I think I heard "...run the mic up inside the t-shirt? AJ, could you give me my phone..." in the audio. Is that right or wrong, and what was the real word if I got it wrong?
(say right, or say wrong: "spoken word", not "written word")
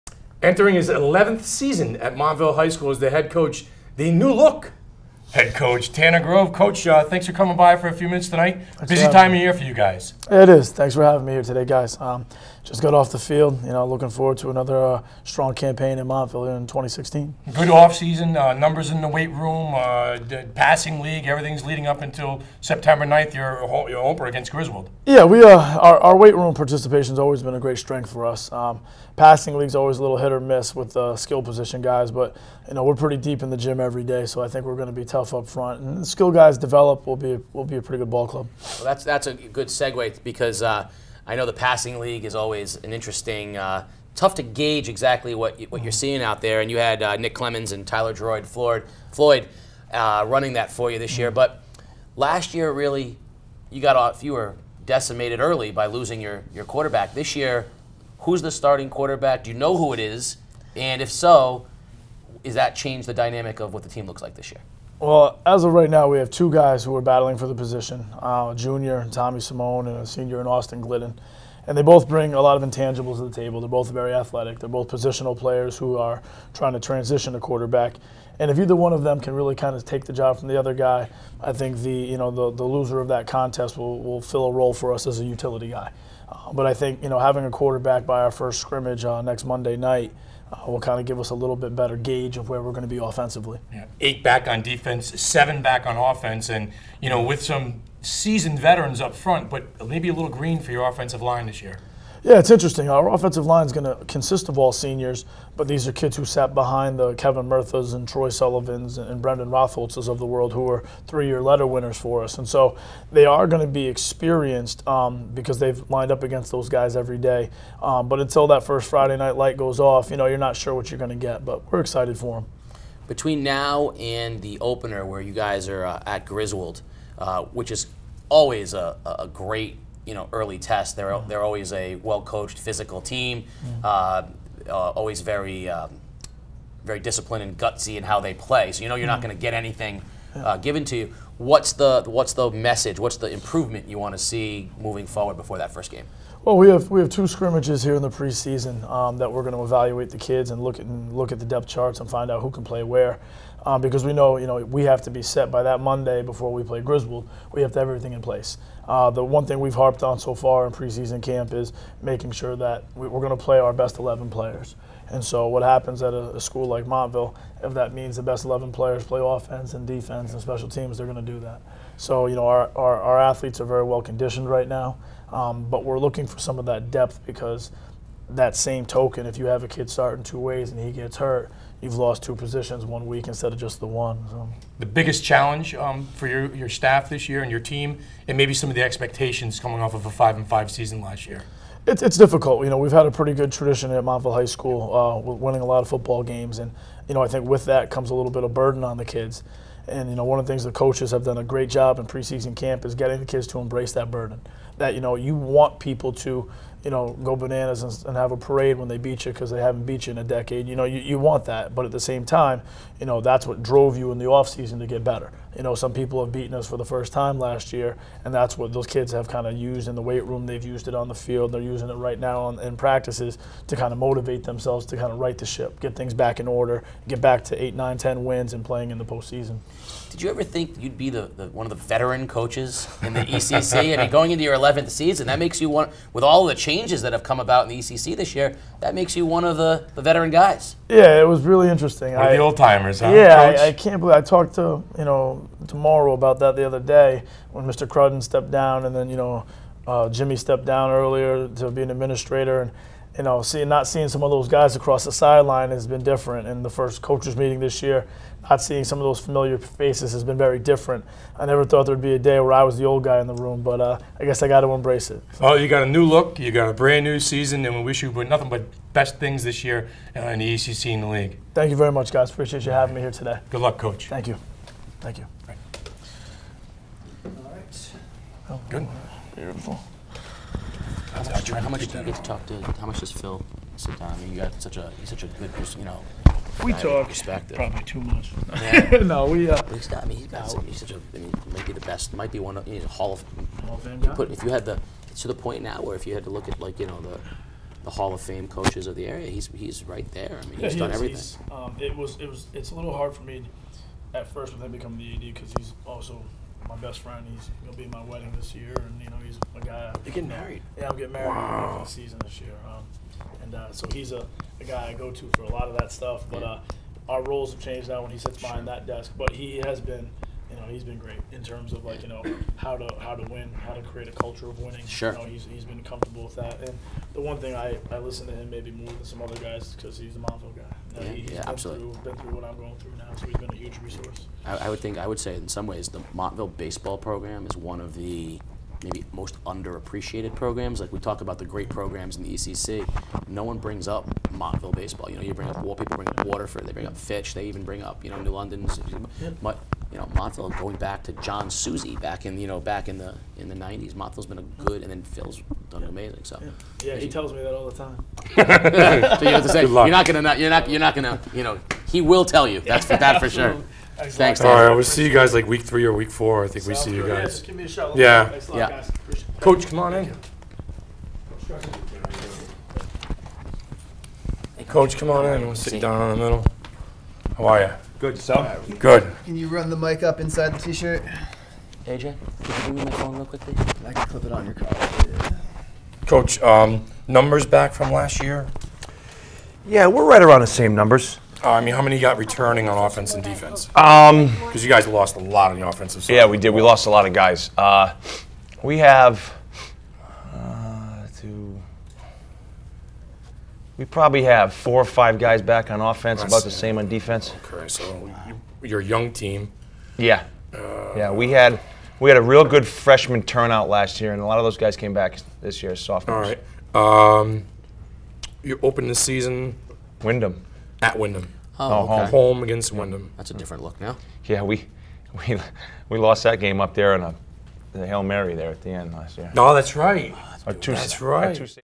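right.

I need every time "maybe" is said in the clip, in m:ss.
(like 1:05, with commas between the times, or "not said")
1:39, 3:08, 5:28, 5:38.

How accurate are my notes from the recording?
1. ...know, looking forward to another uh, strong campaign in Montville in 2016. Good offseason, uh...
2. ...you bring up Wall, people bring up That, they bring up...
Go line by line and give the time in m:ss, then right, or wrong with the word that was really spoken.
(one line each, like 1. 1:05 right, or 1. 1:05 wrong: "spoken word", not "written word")
1. 0:13 right
2. 5:45 wrong: "Waterford", not "That".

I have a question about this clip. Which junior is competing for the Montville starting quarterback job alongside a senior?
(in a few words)
Tommy Simone.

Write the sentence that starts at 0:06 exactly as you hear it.
Coach, uh, thanks for coming by for a few minutes tonight.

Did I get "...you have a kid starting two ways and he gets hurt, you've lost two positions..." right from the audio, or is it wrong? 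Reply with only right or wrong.
right.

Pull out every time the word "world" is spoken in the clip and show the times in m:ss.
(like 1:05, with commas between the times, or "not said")
1:50.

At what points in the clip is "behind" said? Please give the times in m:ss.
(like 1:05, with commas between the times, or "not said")
1:46, 5:18.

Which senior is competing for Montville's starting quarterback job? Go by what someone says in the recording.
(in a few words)
Austin Glidden.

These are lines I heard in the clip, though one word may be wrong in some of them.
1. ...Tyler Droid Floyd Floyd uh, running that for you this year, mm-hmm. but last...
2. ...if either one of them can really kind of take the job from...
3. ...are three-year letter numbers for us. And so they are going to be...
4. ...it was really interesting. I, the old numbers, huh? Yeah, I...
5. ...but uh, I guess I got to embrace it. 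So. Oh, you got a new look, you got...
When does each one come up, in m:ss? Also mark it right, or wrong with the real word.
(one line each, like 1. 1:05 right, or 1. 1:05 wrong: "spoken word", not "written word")
1. 0:47 right
2. 1:18 right
3. 1:50 wrong: "winners", not "numbers"
4. 4:01 wrong: "timers", not "numbers"
5. 4:23 right.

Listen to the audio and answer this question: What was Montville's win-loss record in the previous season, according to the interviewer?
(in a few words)
5 and 5.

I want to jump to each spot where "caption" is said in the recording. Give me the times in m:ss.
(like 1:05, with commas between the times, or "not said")
not said.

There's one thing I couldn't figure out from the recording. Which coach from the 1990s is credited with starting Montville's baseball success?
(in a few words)
John Susie.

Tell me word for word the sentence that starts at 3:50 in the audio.
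Did you ever think you'd be the, the one of the veteran coaches in the ECC?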